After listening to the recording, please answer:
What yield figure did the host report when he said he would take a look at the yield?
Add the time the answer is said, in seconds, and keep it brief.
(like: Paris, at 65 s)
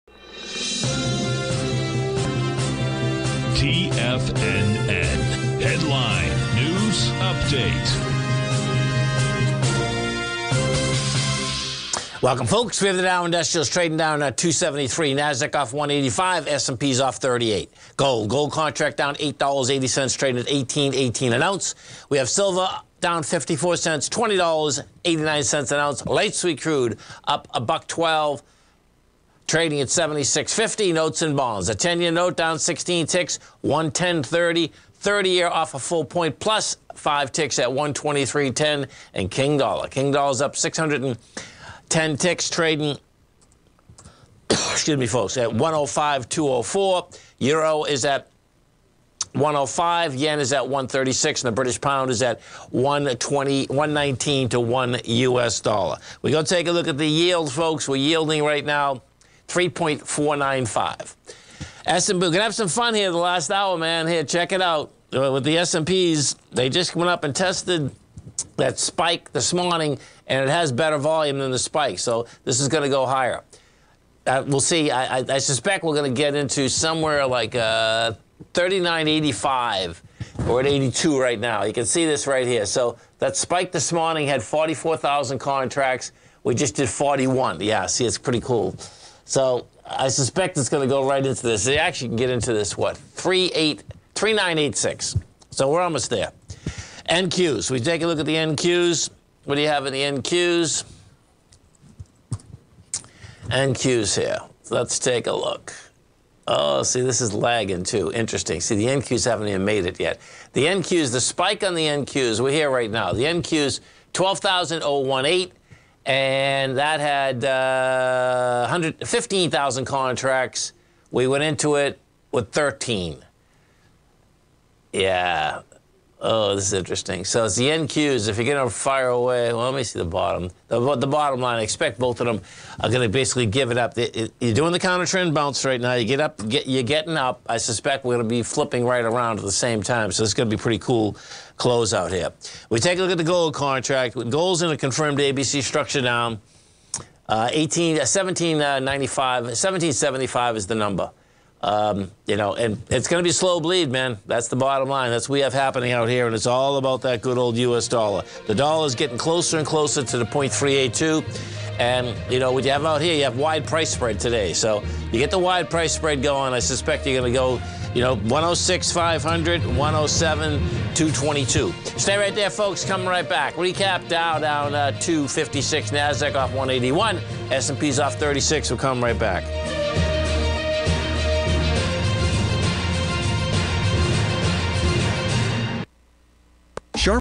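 3.495, at 59 s.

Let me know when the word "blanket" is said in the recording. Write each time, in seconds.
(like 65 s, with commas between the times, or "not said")
not said.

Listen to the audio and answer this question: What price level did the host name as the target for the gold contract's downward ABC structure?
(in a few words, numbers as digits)
1775.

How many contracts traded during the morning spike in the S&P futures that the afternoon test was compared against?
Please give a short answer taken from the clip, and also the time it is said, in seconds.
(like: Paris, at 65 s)
44,000, at 84 s.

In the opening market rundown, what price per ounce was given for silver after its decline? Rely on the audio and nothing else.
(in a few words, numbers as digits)
$20.89.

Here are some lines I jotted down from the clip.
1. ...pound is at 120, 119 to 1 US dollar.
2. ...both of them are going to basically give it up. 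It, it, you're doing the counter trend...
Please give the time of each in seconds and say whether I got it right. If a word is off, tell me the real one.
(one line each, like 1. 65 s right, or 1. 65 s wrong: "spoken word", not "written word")
1. 51 s right
2. 131 s right.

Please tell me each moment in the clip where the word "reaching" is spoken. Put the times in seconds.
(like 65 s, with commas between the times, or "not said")
not said.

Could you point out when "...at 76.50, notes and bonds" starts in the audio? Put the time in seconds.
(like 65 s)
29 s.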